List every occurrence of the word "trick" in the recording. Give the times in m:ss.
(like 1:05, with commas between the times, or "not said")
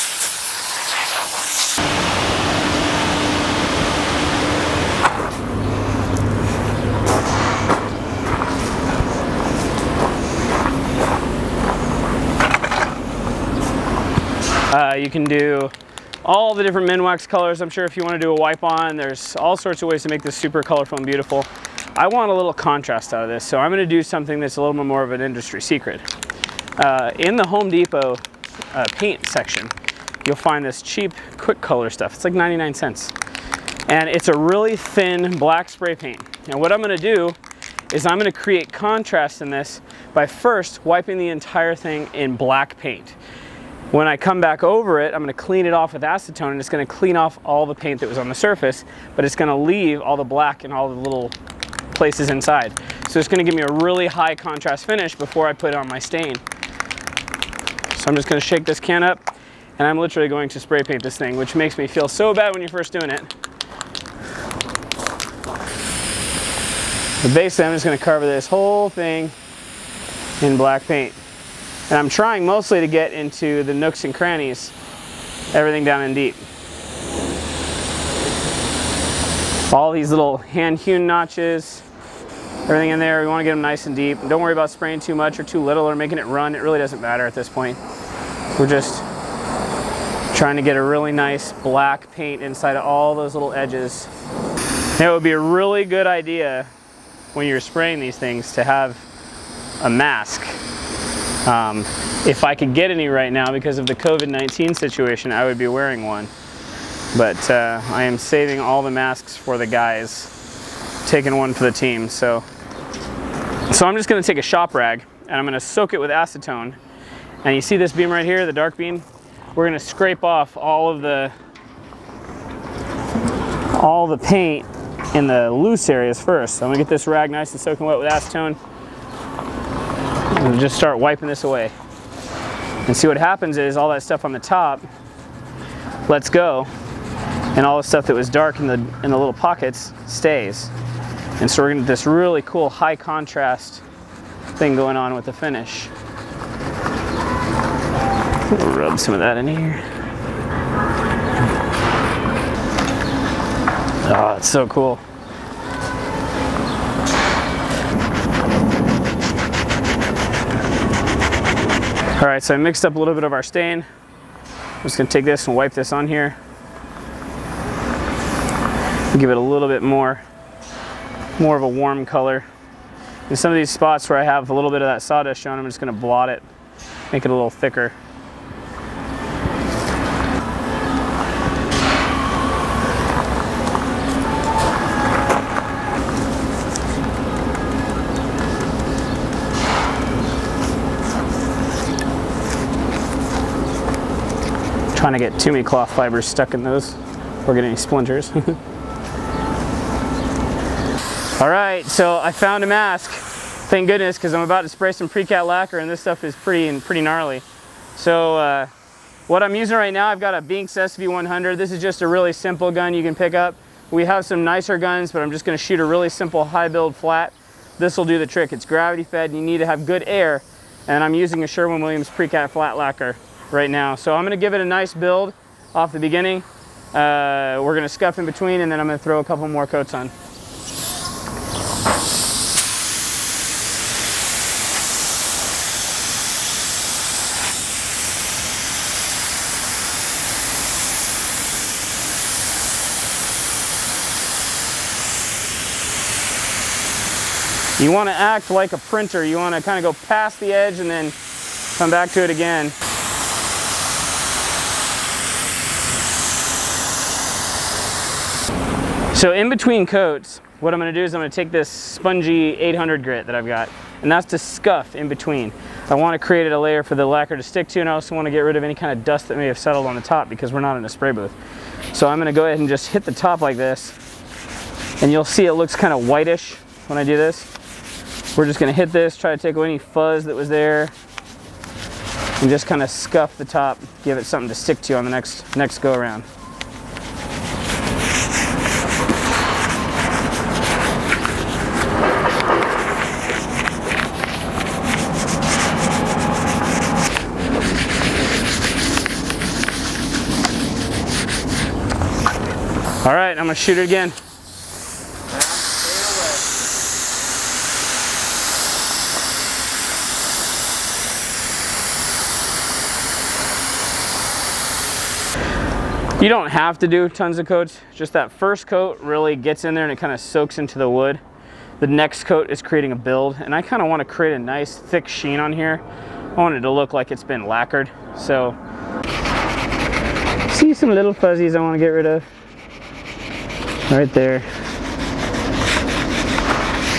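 3:38.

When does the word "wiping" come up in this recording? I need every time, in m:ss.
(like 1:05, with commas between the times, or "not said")
0:40, 2:10.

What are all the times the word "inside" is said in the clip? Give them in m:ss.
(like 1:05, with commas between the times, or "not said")
0:52, 1:32.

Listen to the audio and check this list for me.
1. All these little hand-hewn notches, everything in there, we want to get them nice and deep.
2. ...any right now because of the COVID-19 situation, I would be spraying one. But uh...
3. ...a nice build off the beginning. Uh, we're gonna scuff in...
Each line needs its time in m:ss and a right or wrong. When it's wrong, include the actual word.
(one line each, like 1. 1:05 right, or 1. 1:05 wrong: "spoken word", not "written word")
1. 1:19 right
2. 1:42 wrong: "wearing", not "spraying"
3. 3:44 right.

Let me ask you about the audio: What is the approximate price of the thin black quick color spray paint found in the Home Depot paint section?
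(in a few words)
99 cents.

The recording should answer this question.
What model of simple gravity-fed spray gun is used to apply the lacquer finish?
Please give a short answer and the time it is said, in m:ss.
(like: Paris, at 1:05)
Binks SV100, at 3:30.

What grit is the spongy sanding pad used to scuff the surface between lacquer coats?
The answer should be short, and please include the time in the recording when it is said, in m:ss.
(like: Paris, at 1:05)
800, at 4:22.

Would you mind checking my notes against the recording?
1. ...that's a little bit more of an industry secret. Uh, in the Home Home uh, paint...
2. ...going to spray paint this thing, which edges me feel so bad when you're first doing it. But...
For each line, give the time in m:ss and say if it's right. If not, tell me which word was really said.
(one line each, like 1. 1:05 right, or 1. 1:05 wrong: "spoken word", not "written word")
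1. 0:24 wrong: "Depot", not "Home"
2. 1:00 wrong: "makes", not "edges".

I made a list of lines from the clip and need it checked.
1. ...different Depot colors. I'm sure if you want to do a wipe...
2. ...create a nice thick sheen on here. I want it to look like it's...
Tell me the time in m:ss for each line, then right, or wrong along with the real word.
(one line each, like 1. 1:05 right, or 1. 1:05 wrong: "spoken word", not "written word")
1. 0:16 wrong: "Minwax", not "Depot"
2. 5:24 right.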